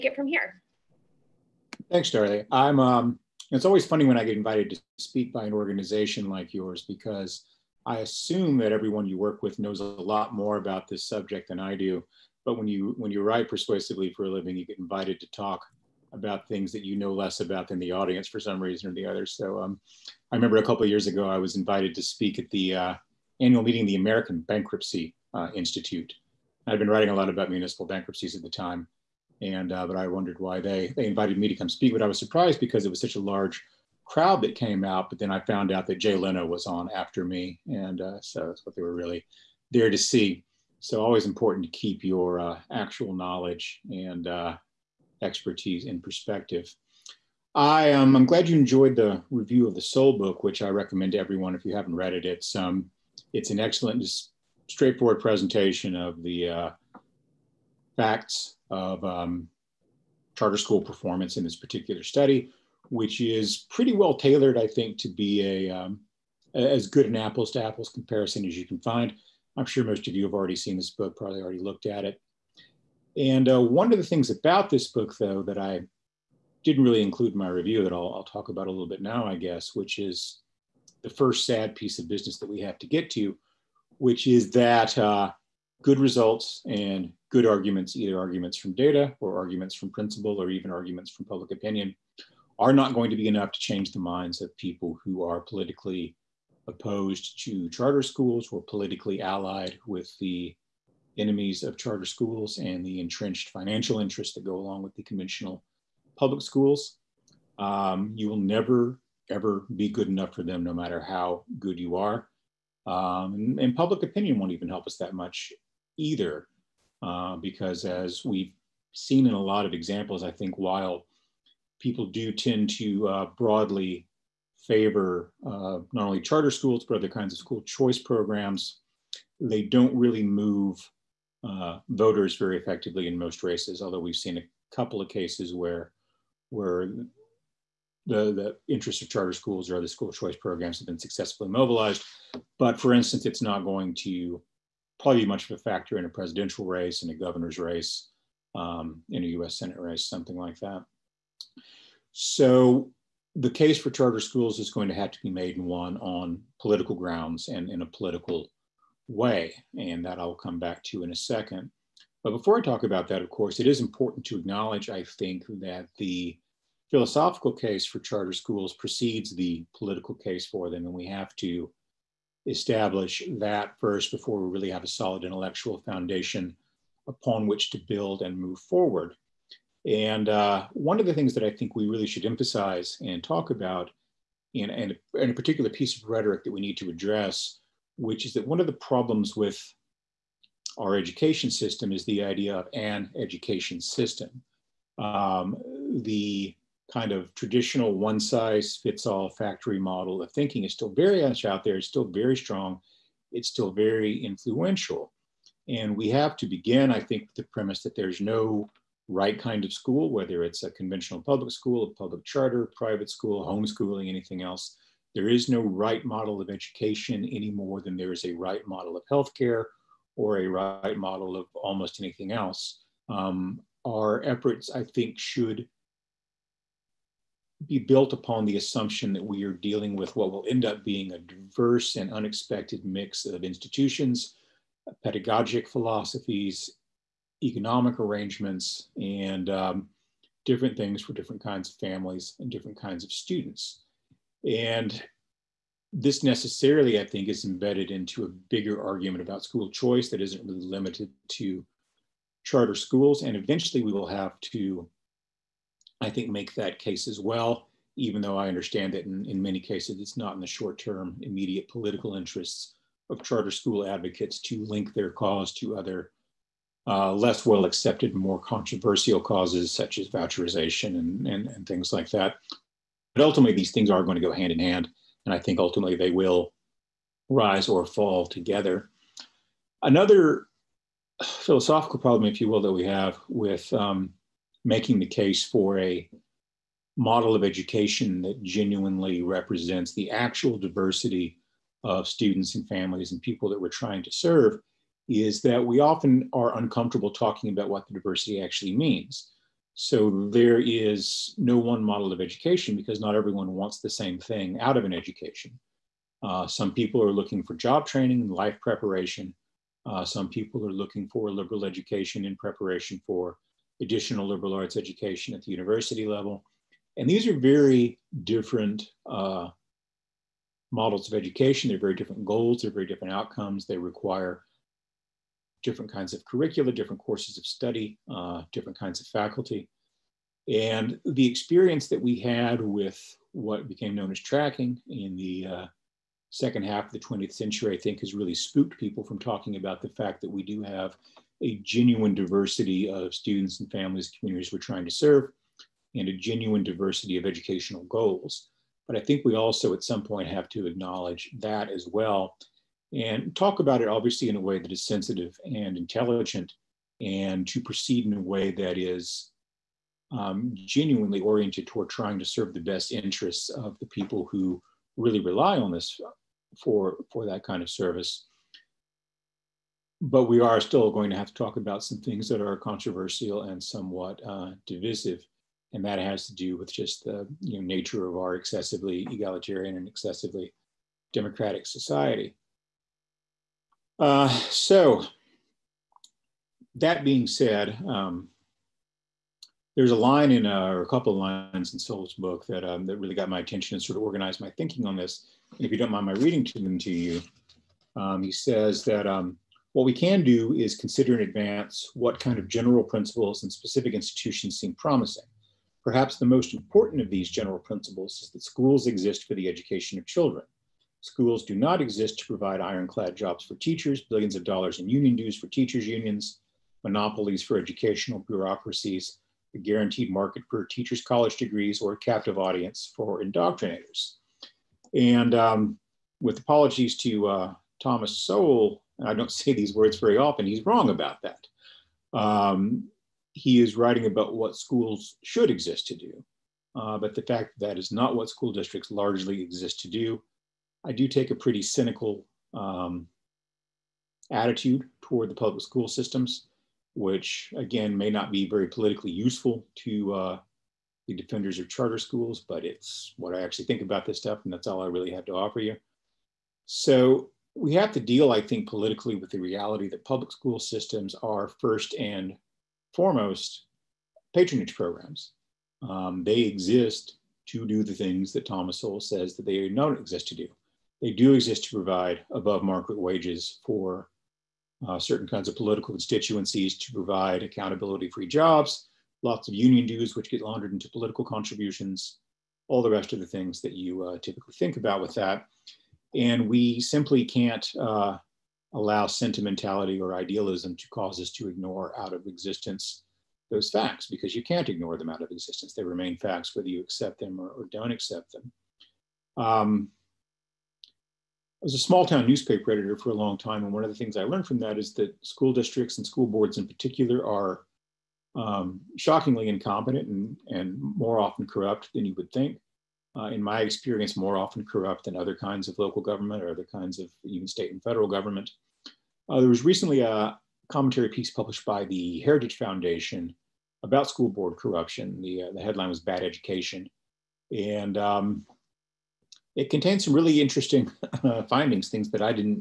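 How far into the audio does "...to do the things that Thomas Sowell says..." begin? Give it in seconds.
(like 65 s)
467 s.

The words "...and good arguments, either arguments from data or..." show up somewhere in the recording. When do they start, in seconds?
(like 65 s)
86 s.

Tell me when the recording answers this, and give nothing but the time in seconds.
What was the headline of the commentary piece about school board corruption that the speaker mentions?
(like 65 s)
525 s.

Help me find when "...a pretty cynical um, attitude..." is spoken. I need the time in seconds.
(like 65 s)
441 s.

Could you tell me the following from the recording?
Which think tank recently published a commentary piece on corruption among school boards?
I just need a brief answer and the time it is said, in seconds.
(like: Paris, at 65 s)
Heritage Foundation, at 522 s.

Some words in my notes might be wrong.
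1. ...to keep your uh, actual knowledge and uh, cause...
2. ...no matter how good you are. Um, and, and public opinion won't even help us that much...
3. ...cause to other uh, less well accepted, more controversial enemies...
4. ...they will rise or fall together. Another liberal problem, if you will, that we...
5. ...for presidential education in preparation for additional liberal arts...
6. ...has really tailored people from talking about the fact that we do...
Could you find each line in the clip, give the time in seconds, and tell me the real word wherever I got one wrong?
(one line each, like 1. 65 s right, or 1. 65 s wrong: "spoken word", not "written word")
1. 41 s wrong: "expertise", not "cause"
2. 110 s right
3. 265 s wrong: "causes", not "enemies"
4. 275 s wrong: "philosophical", not "liberal"
5. 311 s wrong: "liberal", not "presidential"
6. 338 s wrong: "spooked", not "tailored".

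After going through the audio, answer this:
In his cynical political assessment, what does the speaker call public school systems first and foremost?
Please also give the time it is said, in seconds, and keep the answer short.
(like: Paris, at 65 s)
patronage programs, at 464 s.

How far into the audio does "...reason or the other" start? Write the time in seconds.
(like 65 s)
18 s.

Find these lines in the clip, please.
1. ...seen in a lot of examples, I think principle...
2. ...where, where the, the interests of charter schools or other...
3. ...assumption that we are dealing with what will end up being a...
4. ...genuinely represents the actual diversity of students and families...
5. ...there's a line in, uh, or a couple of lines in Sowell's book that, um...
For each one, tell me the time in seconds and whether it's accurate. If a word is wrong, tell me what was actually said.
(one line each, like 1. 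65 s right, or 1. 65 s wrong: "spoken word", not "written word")
1. 118 s wrong: "while", not "principle"
2. 135 s right
3. 228 s right
4. 288 s right
5. 389 s right.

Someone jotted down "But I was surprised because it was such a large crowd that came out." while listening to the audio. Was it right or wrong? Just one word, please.
right.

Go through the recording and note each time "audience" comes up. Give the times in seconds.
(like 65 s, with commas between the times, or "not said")
17 s, 422 s.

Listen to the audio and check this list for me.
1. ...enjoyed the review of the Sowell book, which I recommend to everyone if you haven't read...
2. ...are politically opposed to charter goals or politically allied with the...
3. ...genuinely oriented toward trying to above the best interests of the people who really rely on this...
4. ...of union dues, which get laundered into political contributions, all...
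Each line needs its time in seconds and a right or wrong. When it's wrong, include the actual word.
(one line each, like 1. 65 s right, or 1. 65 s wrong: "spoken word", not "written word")
1. 48 s right
2. 95 s wrong: "schools", not "goals"
3. 360 s wrong: "serve", not "above"
4. 479 s right.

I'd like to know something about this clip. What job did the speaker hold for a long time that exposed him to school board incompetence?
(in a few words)
small town newspaper editor.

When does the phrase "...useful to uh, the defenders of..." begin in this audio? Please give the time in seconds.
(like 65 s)
449 s.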